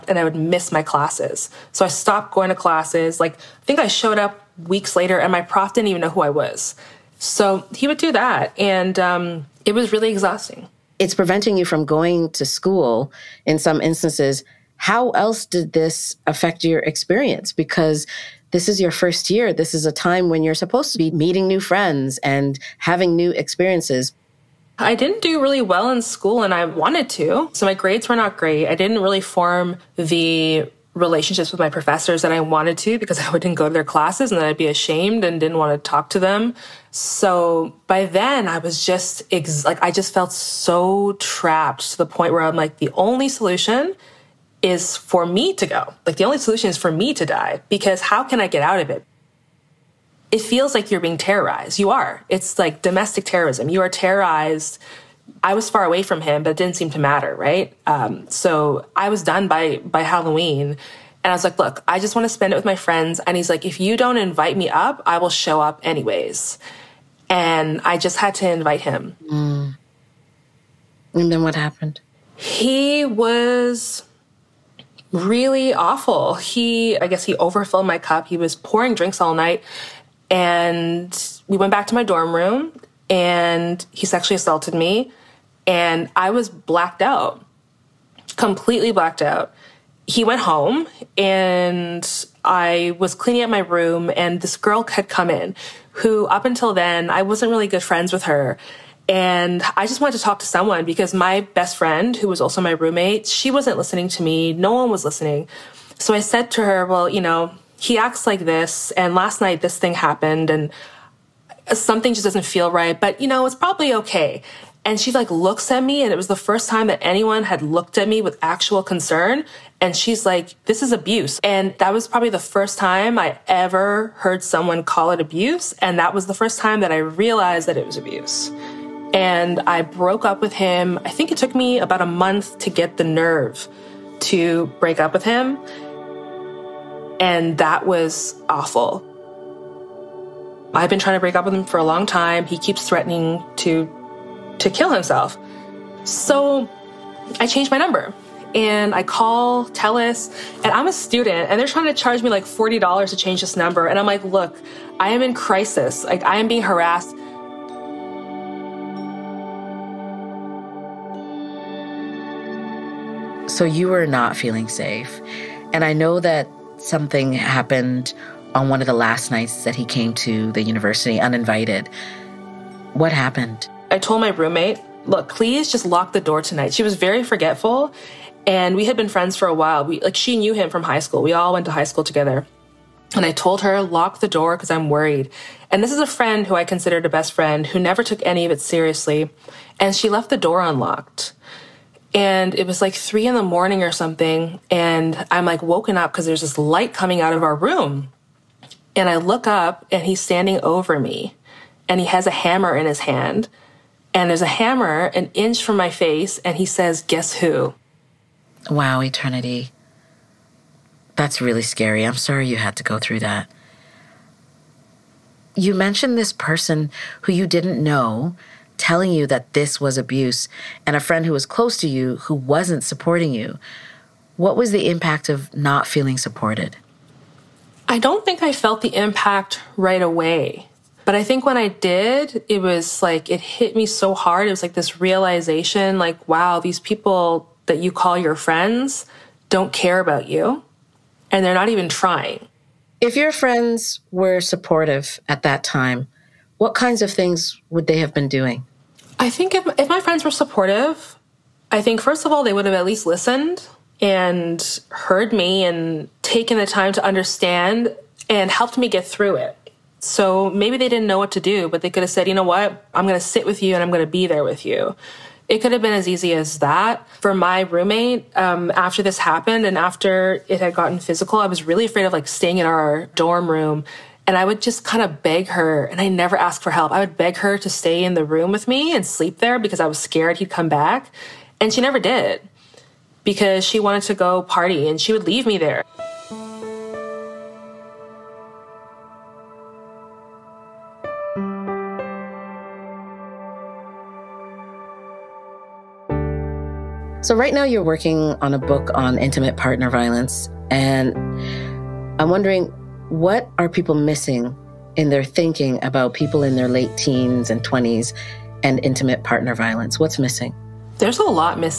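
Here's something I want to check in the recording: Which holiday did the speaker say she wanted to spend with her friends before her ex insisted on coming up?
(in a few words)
Halloween.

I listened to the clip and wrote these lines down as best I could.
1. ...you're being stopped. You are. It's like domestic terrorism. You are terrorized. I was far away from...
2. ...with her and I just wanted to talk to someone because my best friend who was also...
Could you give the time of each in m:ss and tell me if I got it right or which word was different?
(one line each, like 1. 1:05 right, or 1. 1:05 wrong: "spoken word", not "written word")
1. 0:50 wrong: "terrorized", not "stopped"
2. 1:38 right.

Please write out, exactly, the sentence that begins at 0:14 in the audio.
How else did this affect your experience?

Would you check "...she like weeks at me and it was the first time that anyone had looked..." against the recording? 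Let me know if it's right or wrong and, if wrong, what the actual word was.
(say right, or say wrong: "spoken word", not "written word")
wrong: "looks", not "weeks".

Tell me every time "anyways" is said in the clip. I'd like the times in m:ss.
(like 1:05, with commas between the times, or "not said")
1:05.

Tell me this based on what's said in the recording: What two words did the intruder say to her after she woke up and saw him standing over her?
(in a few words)
Guess who.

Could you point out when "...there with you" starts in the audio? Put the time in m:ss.
4:24.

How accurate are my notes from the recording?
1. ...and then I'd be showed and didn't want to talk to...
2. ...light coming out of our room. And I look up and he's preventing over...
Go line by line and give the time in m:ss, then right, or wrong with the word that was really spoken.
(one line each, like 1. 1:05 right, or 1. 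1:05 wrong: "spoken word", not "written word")
1. 0:34 wrong: "ashamed", not "showed"
2. 3:16 wrong: "standing", not "preventing".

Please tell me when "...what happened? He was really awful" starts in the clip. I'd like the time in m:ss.
1:11.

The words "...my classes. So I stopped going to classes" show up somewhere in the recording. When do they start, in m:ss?
0:00.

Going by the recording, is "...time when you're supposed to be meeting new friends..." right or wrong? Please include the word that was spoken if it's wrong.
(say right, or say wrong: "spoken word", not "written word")
right.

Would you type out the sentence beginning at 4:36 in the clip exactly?
I would beg her to stay in the room with me and sleep there because I was scared he'd come back.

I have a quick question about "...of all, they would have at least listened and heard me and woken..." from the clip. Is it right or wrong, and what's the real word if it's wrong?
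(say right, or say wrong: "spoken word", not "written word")
wrong: "taken", not "woken".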